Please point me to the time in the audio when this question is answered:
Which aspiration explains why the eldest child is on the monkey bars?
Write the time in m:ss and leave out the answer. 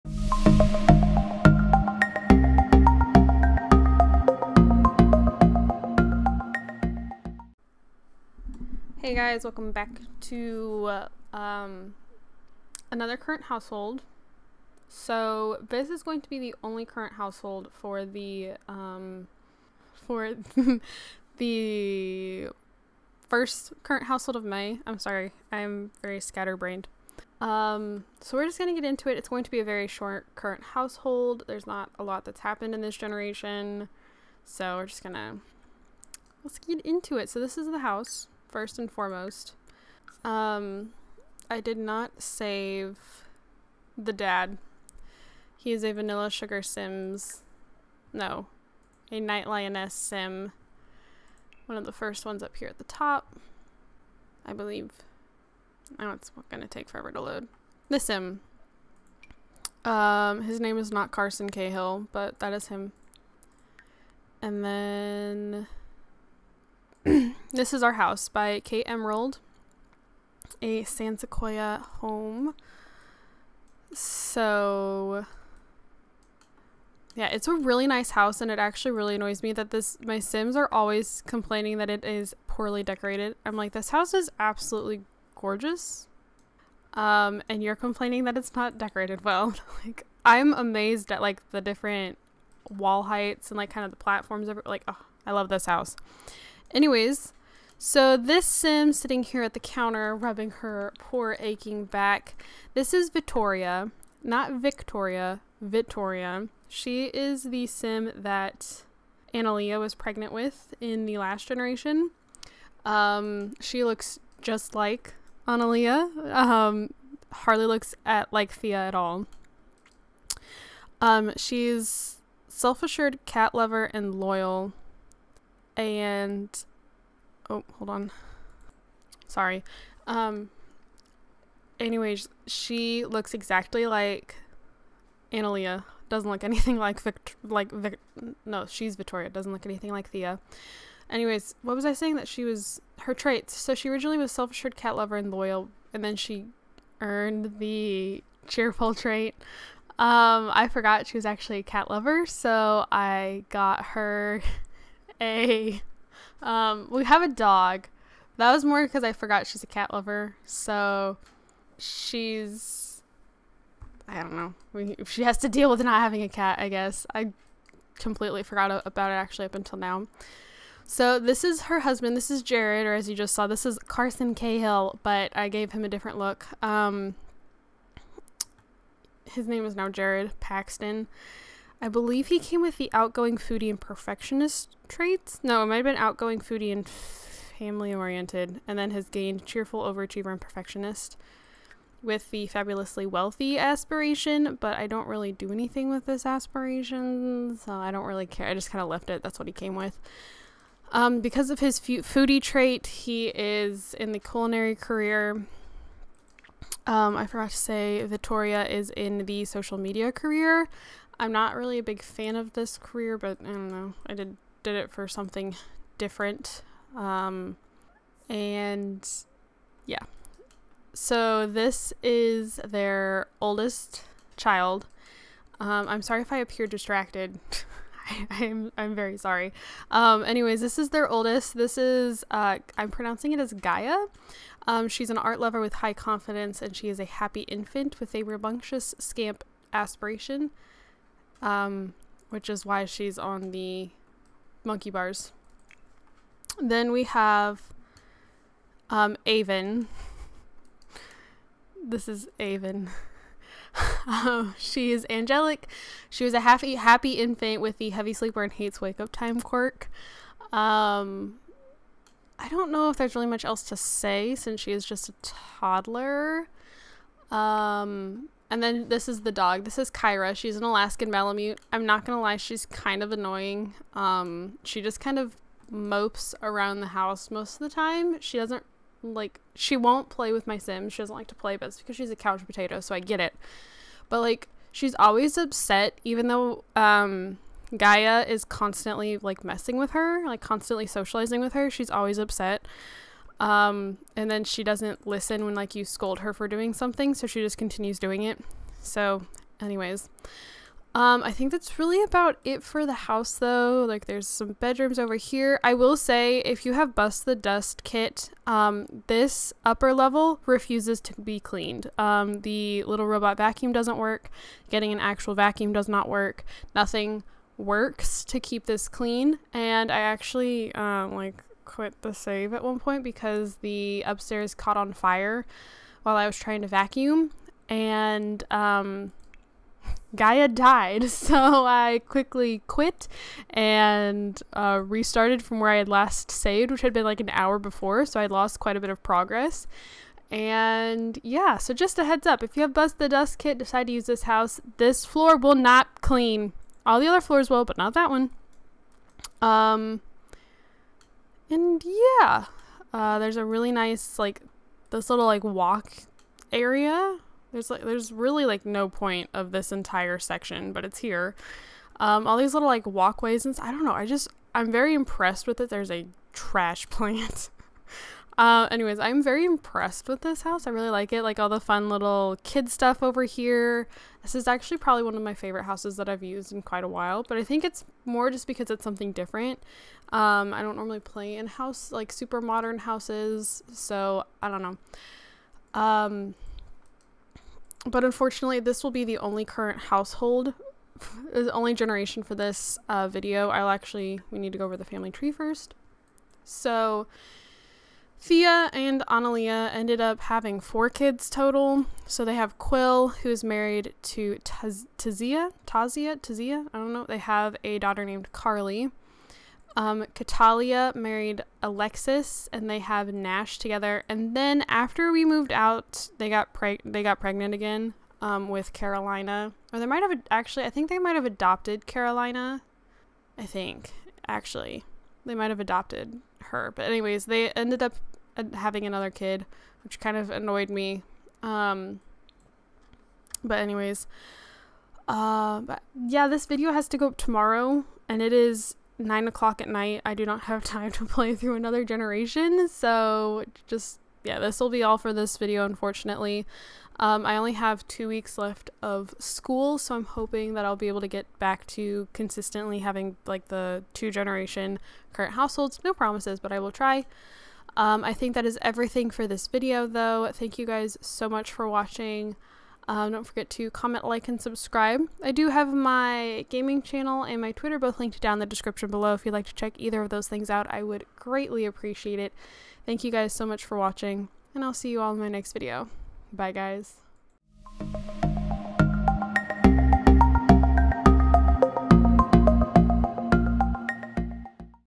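3:58.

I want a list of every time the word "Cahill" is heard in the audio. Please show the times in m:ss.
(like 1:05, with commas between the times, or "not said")
1:01, 2:54.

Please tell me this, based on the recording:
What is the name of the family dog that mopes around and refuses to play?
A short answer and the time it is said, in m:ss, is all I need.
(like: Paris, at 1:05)
Kyra, at 4:29.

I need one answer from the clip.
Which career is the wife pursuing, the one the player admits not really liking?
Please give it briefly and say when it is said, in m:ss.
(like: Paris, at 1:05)
social media, at 3:29.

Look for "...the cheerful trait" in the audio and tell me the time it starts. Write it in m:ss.
2:27.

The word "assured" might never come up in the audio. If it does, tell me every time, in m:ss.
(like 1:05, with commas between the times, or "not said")
2:02, 2:24.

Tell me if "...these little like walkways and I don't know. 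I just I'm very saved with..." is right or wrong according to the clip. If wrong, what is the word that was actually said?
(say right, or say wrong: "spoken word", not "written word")
wrong: "impressed", not "saved".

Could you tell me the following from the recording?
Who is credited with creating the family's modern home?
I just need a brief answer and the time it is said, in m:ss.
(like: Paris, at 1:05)
Kate Emerald, at 1:08.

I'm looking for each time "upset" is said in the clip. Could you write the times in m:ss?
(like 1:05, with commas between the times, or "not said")
4:45, 4:52.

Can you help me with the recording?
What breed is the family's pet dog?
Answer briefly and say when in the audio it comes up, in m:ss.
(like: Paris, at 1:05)
Alaskan Malamute, at 4:30.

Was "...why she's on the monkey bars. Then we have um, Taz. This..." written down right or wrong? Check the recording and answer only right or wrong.
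wrong.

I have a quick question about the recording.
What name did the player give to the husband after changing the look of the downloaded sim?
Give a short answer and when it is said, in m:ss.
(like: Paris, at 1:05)
Jared Paxton, at 2:59.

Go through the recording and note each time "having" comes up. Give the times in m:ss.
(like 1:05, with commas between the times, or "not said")
2:46, 6:40, 7:08, 7:32.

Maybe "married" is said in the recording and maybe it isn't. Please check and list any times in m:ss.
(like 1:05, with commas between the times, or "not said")
6:43, 6:50.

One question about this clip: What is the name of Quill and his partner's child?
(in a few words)
Carly.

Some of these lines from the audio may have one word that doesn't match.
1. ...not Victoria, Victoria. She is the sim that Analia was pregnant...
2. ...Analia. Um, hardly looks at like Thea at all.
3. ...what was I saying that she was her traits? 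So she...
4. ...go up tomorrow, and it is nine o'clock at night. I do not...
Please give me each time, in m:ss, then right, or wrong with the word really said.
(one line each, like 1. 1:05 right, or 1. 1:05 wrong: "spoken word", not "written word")
1. 1:44 right
2. 1:55 right
3. 2:21 right
4. 7:16 right.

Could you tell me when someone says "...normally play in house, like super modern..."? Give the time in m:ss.
6:20.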